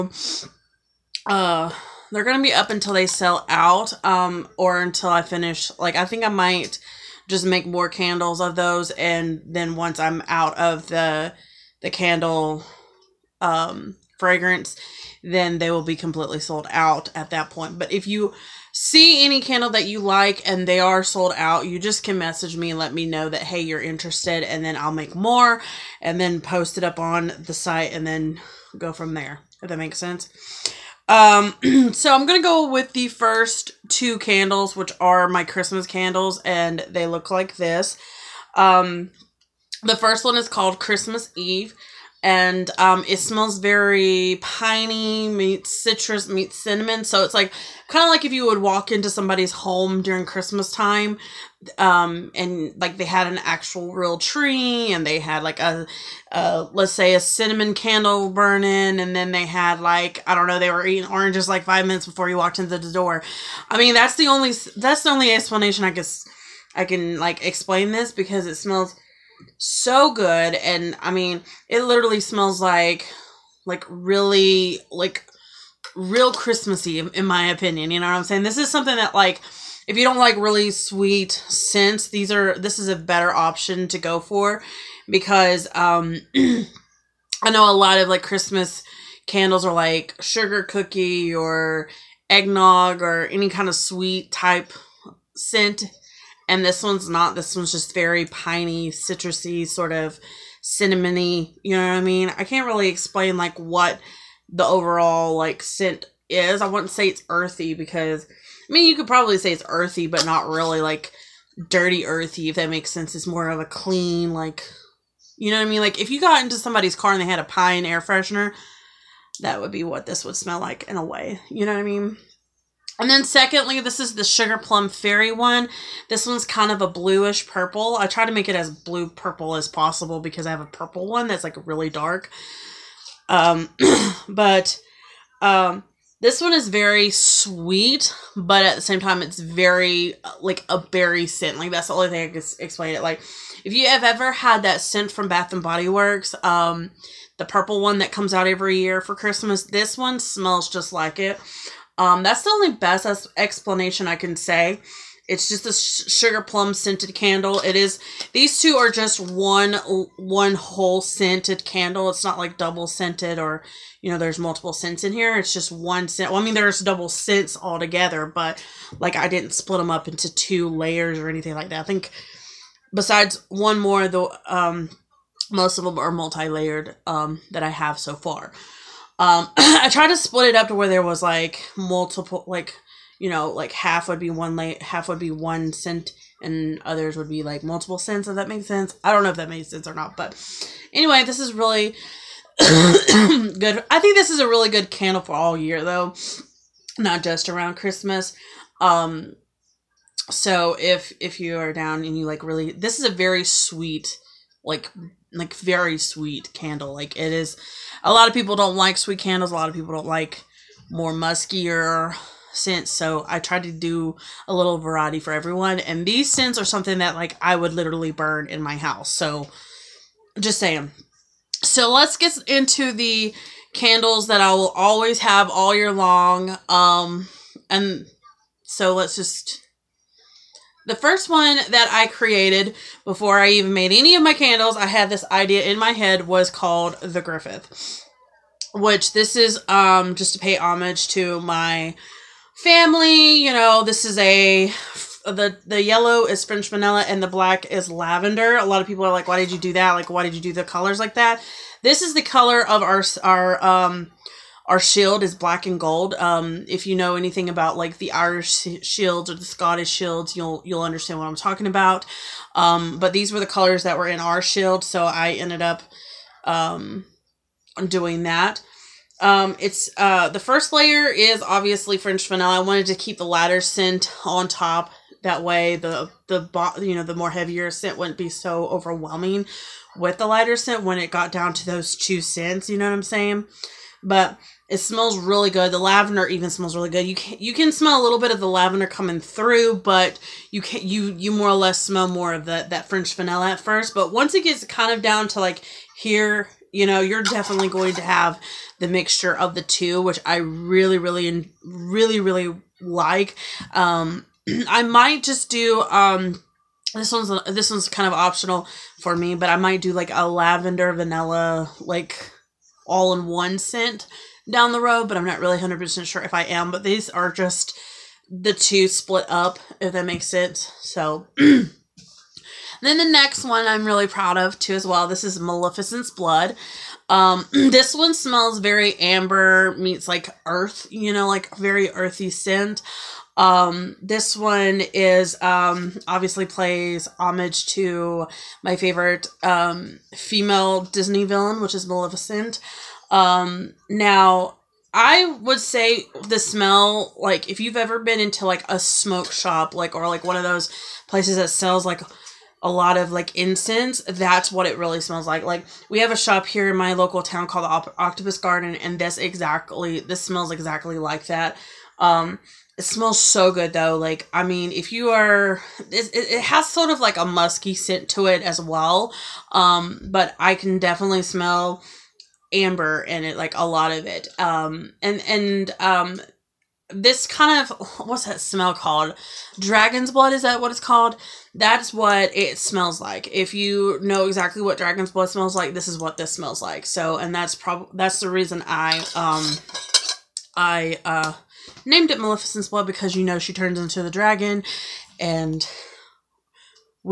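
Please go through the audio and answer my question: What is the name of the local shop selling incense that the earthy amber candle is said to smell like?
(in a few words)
Octopus Garden.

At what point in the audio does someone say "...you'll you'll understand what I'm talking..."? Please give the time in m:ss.
4:20.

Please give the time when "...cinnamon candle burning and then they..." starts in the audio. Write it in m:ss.
0:57.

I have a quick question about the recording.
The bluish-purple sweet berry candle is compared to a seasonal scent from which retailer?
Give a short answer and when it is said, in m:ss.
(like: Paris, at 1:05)
Bath and Body Works, at 2:25.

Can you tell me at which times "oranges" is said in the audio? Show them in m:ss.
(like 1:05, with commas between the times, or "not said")
1:01.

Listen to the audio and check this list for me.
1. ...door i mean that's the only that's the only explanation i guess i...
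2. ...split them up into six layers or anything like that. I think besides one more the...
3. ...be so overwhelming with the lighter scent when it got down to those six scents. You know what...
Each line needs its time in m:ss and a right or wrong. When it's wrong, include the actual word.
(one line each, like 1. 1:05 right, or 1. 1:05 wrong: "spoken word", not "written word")
1. 1:02 right
2. 2:49 wrong: "two", not "six"
3. 4:38 wrong: "two", not "six".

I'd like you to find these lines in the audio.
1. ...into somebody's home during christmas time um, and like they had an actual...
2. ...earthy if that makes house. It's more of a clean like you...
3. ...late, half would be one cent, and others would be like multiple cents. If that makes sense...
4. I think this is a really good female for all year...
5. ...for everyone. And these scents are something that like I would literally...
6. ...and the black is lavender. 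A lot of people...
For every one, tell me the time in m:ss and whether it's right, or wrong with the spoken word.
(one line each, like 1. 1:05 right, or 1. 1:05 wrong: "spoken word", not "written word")
1. 0:48 right
2. 1:52 wrong: "sense", not "house"
3. 3:04 right
4. 3:13 wrong: "candle", not "female"
5. 3:35 right
6. 4:07 right.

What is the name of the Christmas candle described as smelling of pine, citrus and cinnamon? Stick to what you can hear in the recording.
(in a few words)
Christmas Eve.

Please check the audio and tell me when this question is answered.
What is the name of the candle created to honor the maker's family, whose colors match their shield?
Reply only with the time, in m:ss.
3:57.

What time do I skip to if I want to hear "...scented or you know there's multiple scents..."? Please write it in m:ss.
2:42.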